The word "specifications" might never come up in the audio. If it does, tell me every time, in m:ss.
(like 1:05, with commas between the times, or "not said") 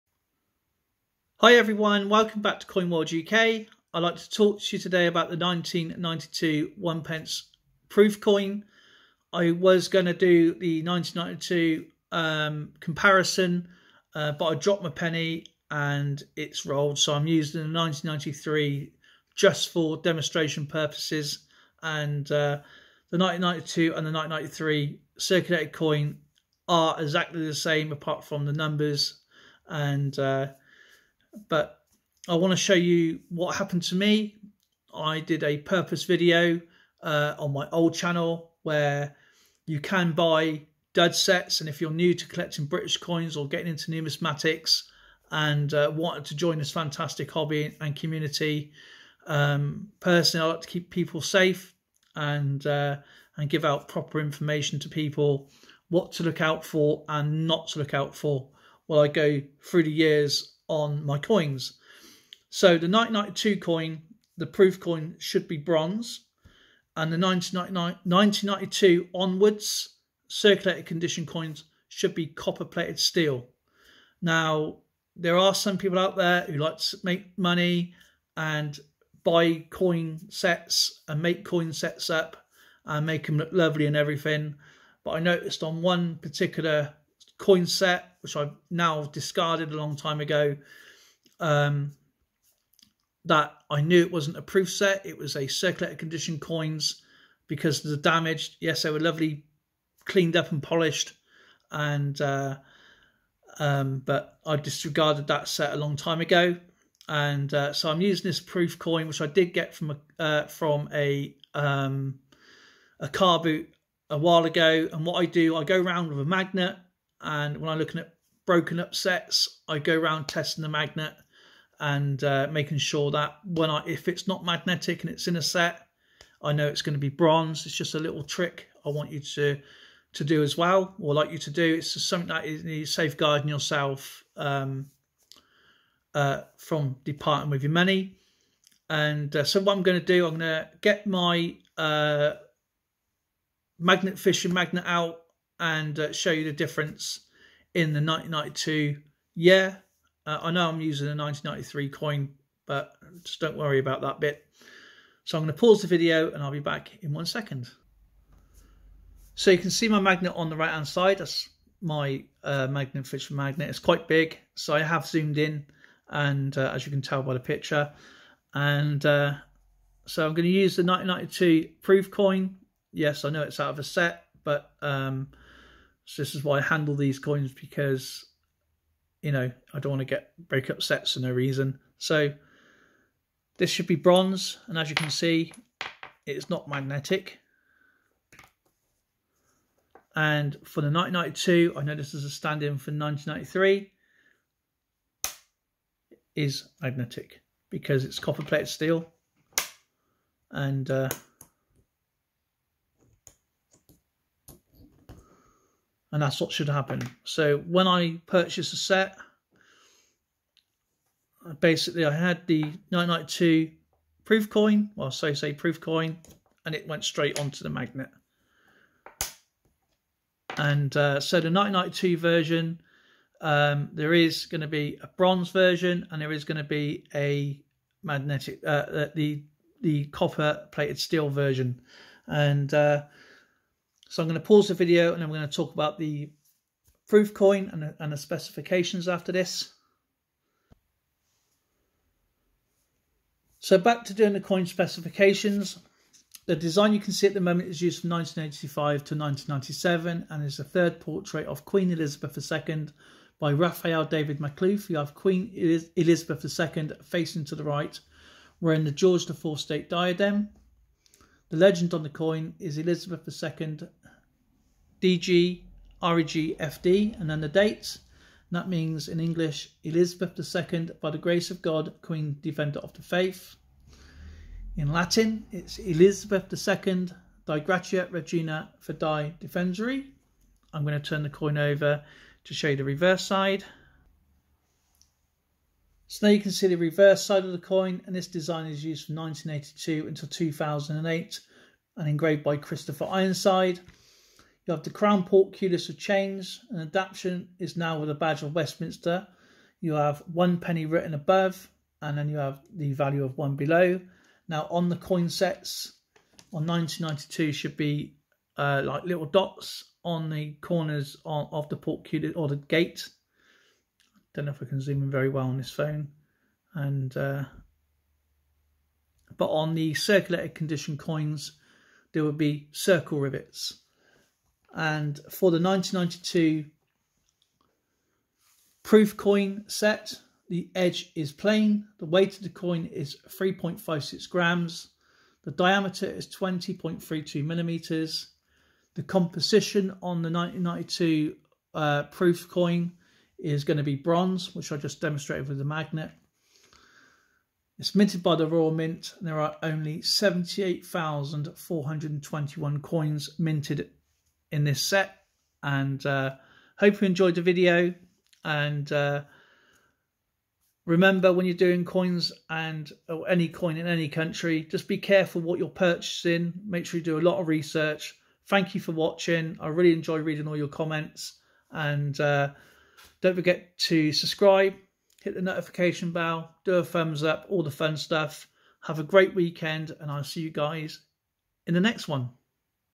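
3:58, 4:04.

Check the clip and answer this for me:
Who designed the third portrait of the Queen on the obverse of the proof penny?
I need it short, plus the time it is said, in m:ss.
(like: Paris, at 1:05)
Raphael David Maklouf, at 4:13.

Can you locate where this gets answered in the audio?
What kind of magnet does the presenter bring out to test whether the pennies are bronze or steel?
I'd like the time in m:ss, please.
2:23.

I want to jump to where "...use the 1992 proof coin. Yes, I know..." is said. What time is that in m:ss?
2:50.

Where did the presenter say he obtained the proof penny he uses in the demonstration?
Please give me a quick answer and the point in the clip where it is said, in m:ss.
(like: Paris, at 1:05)
A car boot, at 1:52.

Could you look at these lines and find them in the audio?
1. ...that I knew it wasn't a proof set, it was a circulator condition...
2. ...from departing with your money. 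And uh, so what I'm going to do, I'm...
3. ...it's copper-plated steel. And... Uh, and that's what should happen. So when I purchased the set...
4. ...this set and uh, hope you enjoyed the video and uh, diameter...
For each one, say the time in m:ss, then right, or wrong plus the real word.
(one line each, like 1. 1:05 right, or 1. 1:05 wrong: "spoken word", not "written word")
1. 1:33 right
2. 2:16 right
3. 3:18 right
4. 5:54 wrong: "remember", not "diameter".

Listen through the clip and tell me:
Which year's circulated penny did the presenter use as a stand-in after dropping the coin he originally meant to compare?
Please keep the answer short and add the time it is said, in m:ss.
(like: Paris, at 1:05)
1993, at 0:16.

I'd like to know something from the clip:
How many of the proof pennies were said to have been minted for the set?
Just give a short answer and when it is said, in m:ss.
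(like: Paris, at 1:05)
78,421, at 5:50.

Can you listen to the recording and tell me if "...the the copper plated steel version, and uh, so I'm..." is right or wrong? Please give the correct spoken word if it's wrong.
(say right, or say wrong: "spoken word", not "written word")
right.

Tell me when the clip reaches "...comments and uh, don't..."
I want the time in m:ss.
6:10.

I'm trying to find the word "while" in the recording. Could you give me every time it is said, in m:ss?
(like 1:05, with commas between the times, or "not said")
0:58, 1:54.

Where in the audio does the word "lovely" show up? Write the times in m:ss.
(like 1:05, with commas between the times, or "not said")
1:23, 1:38.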